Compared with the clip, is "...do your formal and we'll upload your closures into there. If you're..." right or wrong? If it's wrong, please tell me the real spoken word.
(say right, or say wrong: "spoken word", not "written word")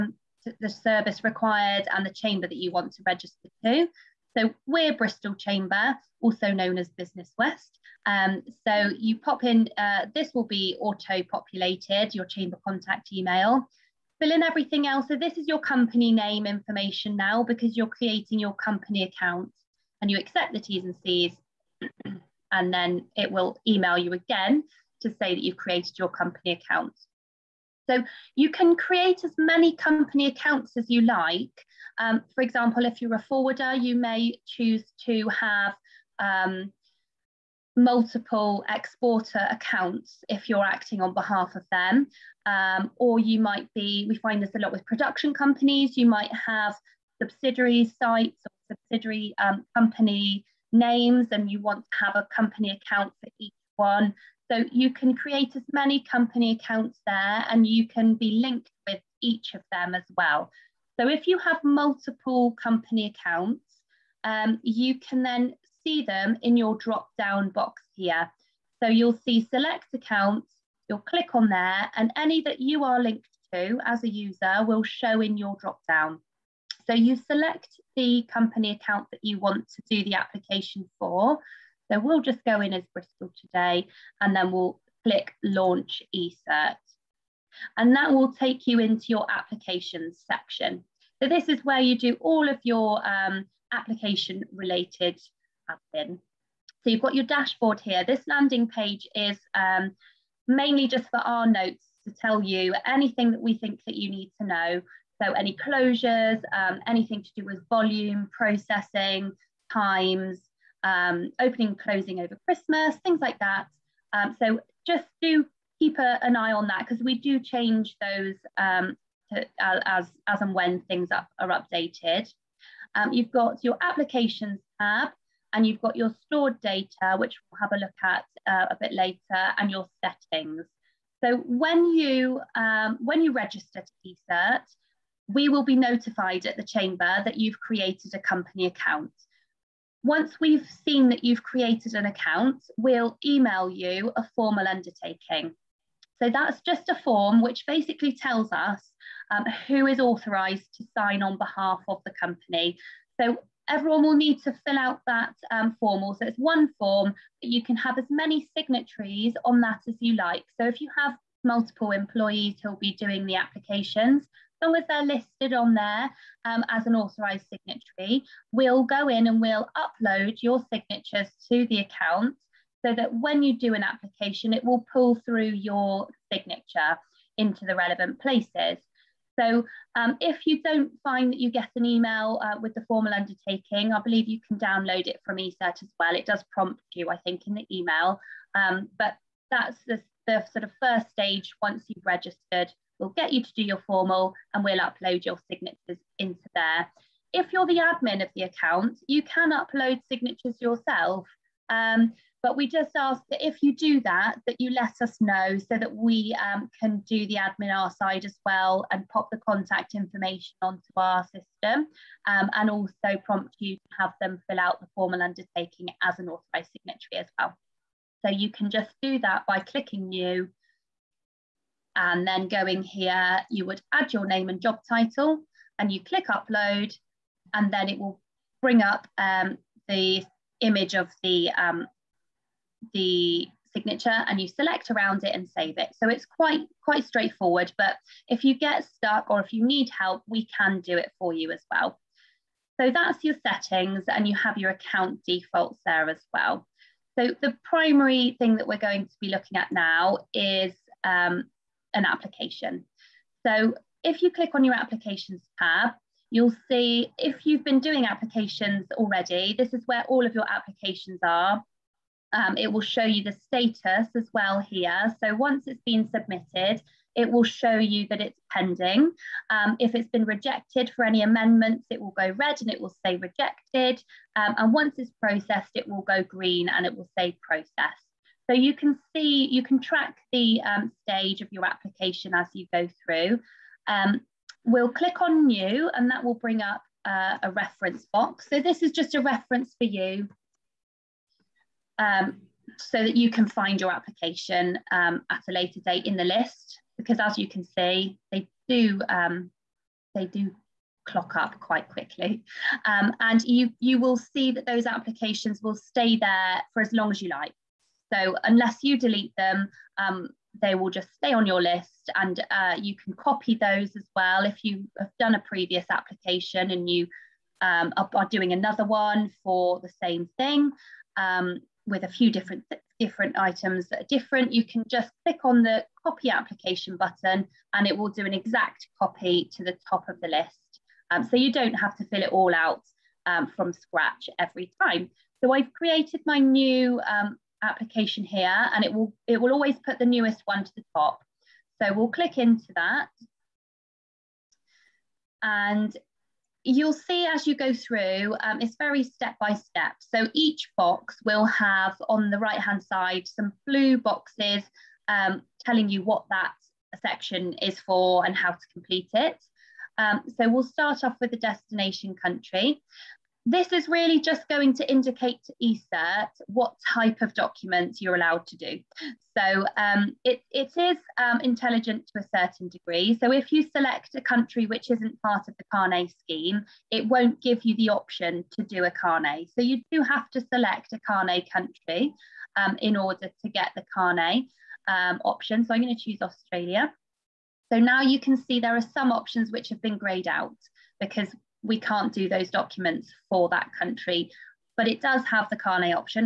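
wrong: "signatures", not "closures".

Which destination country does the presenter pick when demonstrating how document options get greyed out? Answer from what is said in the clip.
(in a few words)
Australia.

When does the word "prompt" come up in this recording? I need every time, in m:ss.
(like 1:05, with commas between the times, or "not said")
3:06, 3:33.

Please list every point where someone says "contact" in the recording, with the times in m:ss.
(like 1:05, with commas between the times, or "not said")
0:12, 3:29.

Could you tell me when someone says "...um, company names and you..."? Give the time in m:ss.
0:49.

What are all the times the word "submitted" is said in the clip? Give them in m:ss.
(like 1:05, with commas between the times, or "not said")
4:26.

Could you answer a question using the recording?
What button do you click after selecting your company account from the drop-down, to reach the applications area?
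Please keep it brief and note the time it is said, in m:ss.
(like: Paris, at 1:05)
launch eCert, at 1:25.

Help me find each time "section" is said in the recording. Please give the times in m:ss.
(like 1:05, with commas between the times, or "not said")
1:30, 5:57.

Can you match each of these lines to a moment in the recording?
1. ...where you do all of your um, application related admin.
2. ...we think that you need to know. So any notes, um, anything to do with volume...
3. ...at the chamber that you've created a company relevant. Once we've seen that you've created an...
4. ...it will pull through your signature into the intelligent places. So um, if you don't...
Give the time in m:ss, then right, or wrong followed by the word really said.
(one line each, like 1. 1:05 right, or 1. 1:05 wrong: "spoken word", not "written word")
1. 1:31 right
2. 1:43 wrong: "closures", not "notes"
3. 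2:16 wrong: "account", not "relevant"
4. 2:54 wrong: "relevant", not "intelligent".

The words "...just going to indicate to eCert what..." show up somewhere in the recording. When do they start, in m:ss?
6:04.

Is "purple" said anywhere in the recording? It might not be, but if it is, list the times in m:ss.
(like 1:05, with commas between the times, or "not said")
not said.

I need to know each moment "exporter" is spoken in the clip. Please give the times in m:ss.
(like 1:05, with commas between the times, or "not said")
0:38.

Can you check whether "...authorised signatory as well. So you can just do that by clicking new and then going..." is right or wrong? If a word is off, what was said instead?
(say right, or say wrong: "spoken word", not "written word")
right.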